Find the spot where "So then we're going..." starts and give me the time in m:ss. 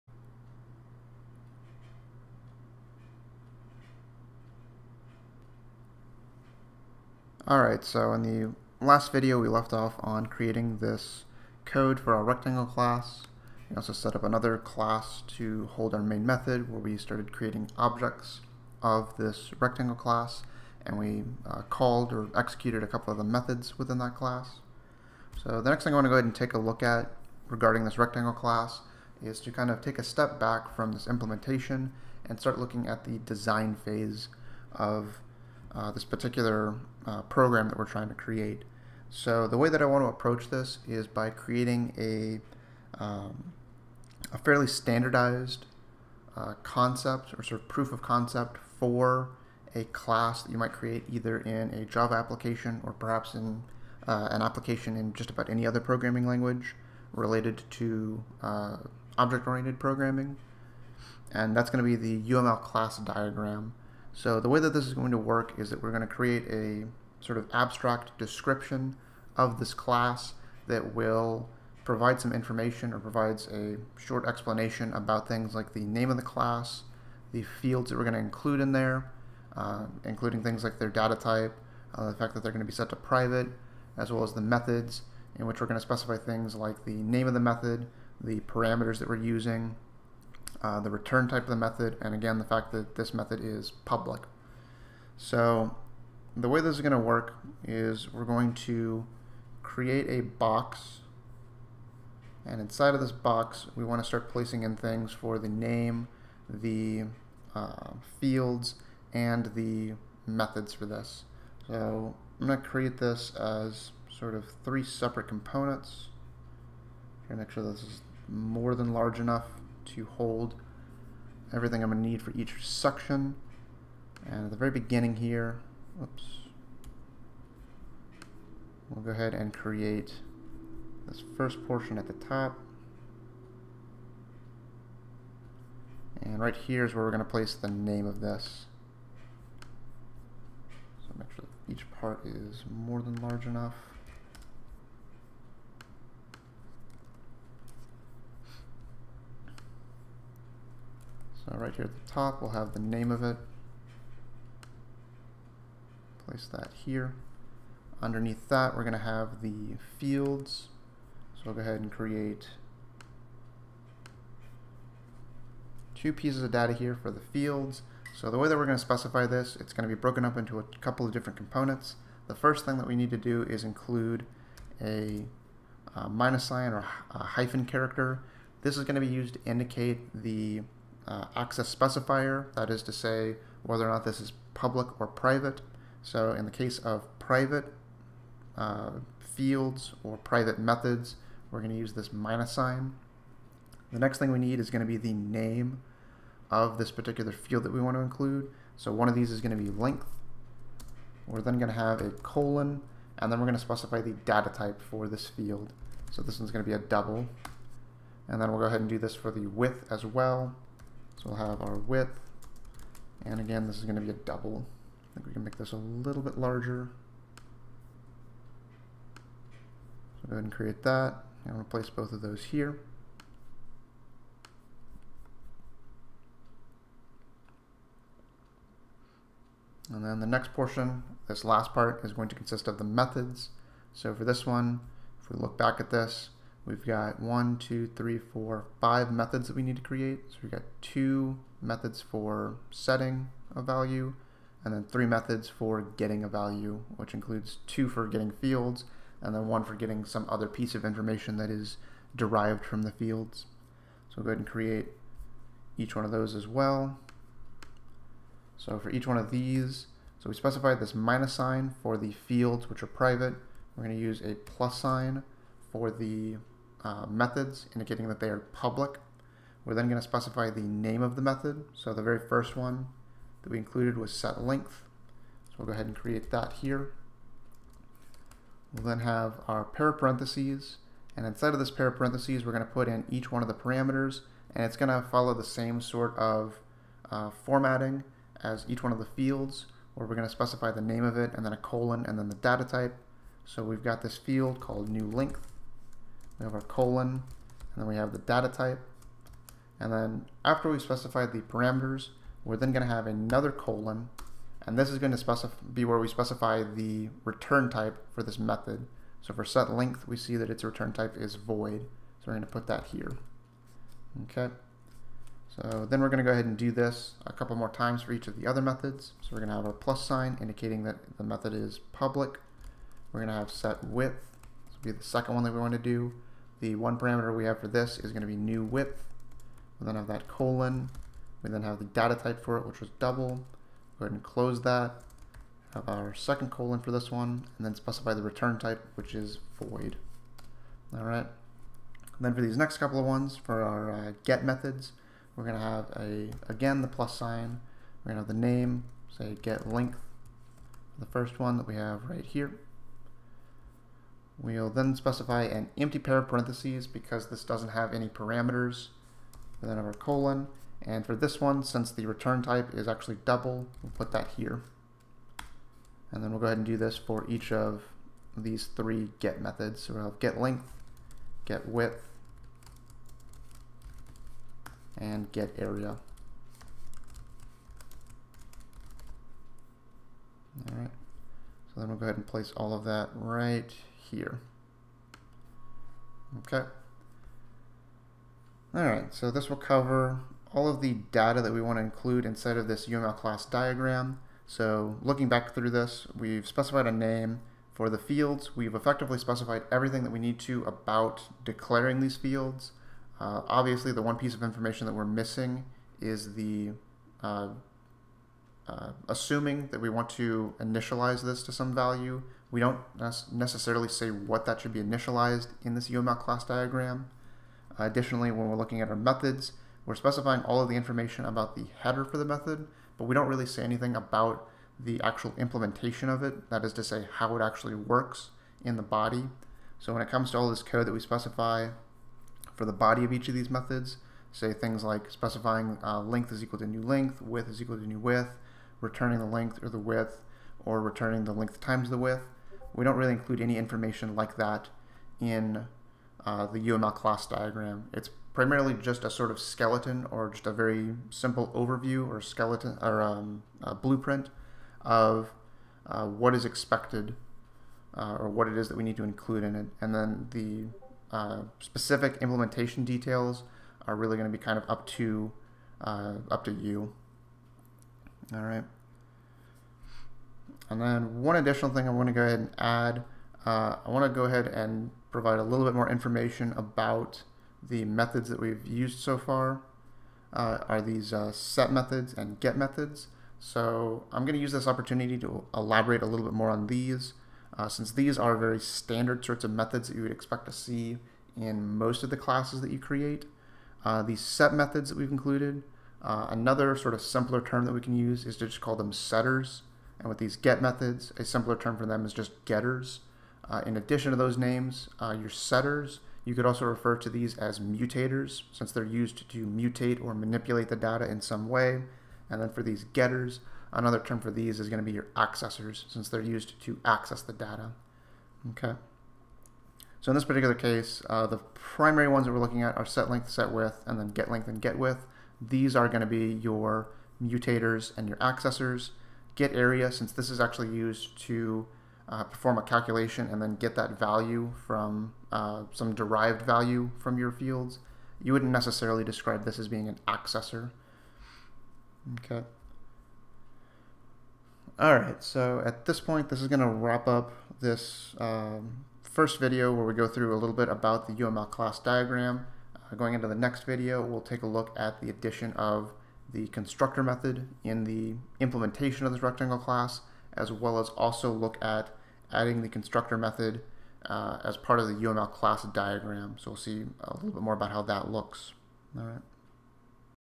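5:15.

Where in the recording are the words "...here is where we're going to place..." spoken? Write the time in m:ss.
2:16.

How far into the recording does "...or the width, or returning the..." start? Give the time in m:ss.
7:19.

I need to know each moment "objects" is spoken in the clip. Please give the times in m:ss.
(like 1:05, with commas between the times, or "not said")
0:17, 0:59.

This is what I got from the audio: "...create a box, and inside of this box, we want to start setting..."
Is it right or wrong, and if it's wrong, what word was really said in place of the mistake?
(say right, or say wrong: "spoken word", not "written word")
wrong: "placing", not "setting".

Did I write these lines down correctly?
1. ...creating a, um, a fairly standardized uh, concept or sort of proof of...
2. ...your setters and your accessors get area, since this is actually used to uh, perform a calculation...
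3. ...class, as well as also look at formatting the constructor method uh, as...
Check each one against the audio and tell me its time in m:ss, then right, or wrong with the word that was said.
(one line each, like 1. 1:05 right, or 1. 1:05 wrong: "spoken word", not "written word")
1. 0:41 right
2. 8:46 wrong: "mutators", not "setters"
3. 9:19 wrong: "adding", not "formatting".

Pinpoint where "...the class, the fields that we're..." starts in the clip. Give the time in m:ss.
1:16.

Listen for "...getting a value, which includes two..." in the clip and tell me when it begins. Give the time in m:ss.
4:05.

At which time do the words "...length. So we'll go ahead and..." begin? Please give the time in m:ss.
4:34.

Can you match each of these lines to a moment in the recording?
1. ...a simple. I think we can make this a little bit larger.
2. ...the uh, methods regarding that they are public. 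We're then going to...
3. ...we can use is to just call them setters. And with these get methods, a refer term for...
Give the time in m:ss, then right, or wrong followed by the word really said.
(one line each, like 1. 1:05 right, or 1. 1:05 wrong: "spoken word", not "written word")
1. 3:34 wrong: "double", not "simple"
2. 4:25 wrong: "indicating", not "regarding"
3. 8:17 wrong: "simpler", not "refer".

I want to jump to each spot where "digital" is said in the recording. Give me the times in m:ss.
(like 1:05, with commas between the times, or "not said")
not said.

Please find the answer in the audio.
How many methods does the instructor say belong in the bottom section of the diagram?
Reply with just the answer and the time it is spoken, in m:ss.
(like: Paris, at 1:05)
5, at 3:58.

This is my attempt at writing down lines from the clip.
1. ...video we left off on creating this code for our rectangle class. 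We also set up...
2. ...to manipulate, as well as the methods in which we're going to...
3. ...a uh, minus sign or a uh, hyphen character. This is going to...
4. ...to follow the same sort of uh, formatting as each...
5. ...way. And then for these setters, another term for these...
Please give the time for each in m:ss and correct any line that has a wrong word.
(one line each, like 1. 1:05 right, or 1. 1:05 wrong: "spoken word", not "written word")
1. 0:09 right
2. 1:22 wrong: "private", not "manipulate"
3. 2:55 right
4. 4:44 right
5. 8:31 wrong: "getters", not "setters".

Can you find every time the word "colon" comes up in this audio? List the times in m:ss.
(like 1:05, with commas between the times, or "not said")
3:22, 4:51, 4:56, 5:03, 5:30, 5:36, 5:59.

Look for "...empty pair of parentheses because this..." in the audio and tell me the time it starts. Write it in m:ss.
5:55.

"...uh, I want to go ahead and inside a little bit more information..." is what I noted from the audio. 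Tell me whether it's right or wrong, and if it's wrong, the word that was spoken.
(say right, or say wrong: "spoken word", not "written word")
wrong: "provide", not "inside".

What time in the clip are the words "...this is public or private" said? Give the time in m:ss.
3:04.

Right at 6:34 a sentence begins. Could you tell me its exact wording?
So looking back through this, we've specified a name for the fields.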